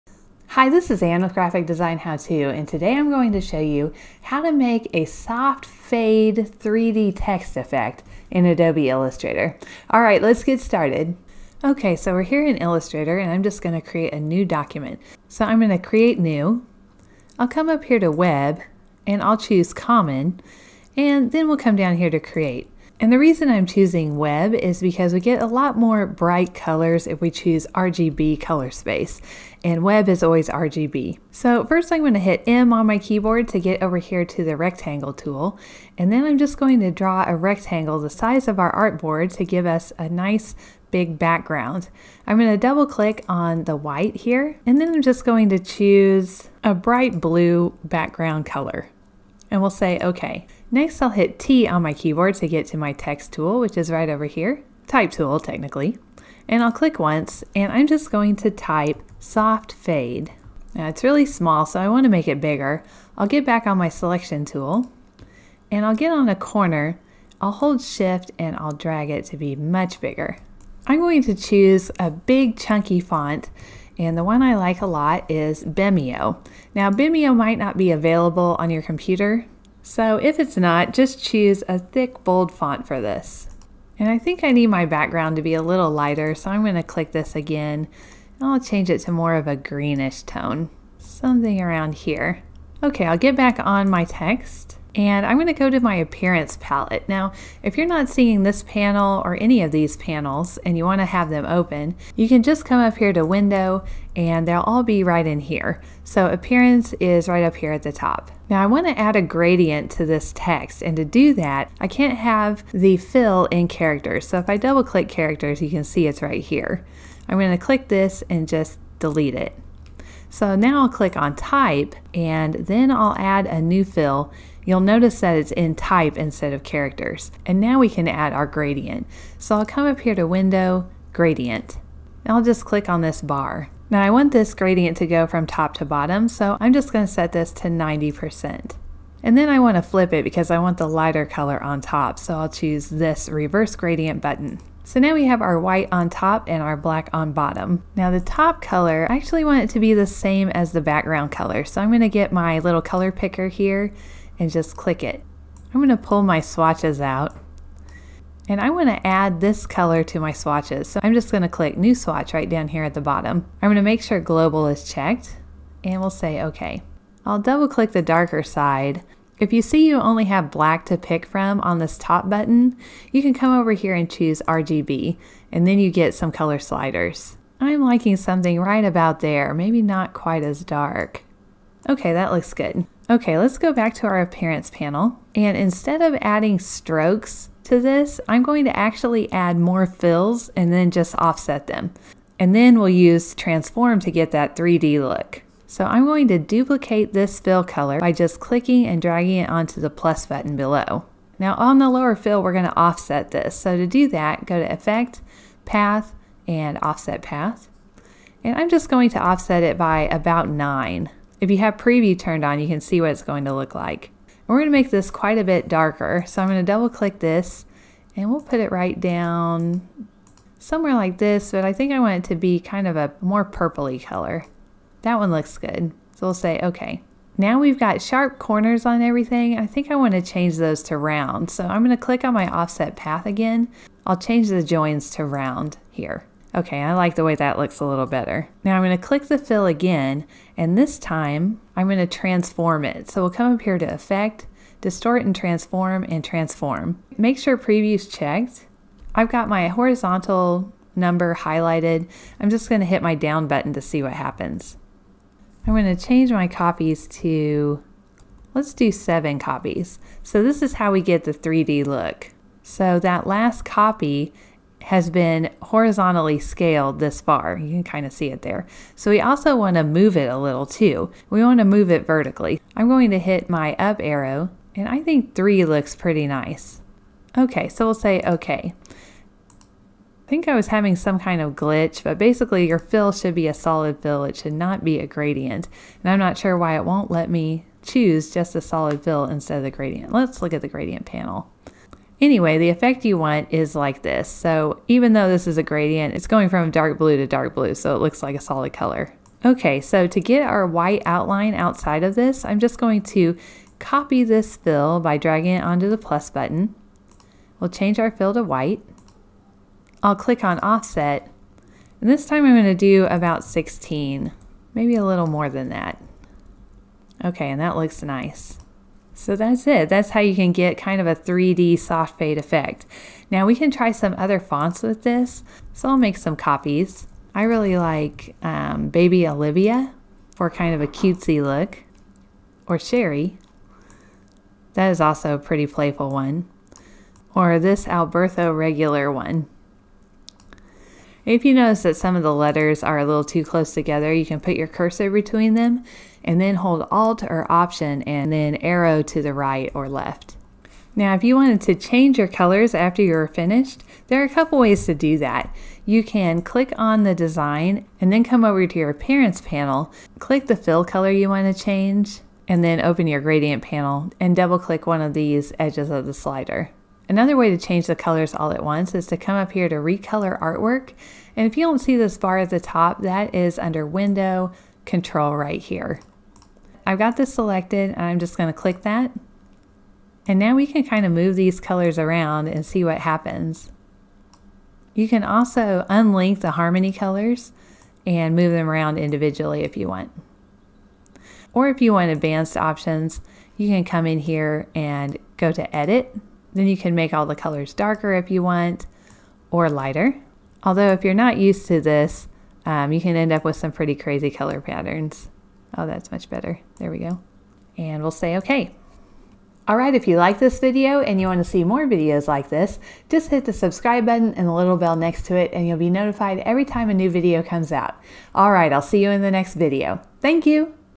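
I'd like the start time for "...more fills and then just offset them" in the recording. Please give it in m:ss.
3:09.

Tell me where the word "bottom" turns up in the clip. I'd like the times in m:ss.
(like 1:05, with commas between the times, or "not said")
2:15, 2:27, 2:43.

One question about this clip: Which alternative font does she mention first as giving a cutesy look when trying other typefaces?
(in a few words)
Baby Olivia.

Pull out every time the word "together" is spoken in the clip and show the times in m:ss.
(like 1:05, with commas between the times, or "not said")
5:43.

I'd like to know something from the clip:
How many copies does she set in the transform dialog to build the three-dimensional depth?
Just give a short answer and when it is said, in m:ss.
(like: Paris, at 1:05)
7, at 4:18.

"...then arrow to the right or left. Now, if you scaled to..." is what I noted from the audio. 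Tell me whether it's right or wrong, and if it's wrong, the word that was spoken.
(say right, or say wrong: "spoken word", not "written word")
wrong: "wanted", not "scaled".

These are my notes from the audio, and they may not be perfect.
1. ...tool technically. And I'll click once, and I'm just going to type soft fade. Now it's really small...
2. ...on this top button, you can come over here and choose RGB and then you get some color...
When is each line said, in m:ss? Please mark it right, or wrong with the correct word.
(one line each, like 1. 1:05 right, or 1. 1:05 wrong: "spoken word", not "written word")
1. 0:55 right
2. 2:51 right.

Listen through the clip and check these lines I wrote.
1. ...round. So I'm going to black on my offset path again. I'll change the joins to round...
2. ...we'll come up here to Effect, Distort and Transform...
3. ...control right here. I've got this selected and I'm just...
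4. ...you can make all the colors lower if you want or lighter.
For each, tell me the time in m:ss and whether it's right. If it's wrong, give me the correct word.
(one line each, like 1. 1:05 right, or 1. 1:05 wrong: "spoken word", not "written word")
1. 3:50 wrong: "click", not "black"
2. 4:03 right
3. 6:14 right
4. 6:36 wrong: "darker", not "lower".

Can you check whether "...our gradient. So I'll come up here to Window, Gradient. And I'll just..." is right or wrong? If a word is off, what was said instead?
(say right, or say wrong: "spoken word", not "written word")
right.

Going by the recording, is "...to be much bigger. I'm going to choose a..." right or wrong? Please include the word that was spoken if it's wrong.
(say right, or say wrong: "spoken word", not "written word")
right.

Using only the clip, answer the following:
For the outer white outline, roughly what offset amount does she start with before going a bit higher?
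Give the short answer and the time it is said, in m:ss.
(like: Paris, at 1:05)
16, at 5:13.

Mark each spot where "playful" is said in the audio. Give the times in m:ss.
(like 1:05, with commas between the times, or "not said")
5:35.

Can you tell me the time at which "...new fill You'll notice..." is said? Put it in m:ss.
2:03.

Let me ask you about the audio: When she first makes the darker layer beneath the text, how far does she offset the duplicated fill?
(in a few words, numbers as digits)
9.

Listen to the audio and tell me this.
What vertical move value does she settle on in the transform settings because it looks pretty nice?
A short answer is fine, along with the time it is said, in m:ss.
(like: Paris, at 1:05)
3, at 4:35.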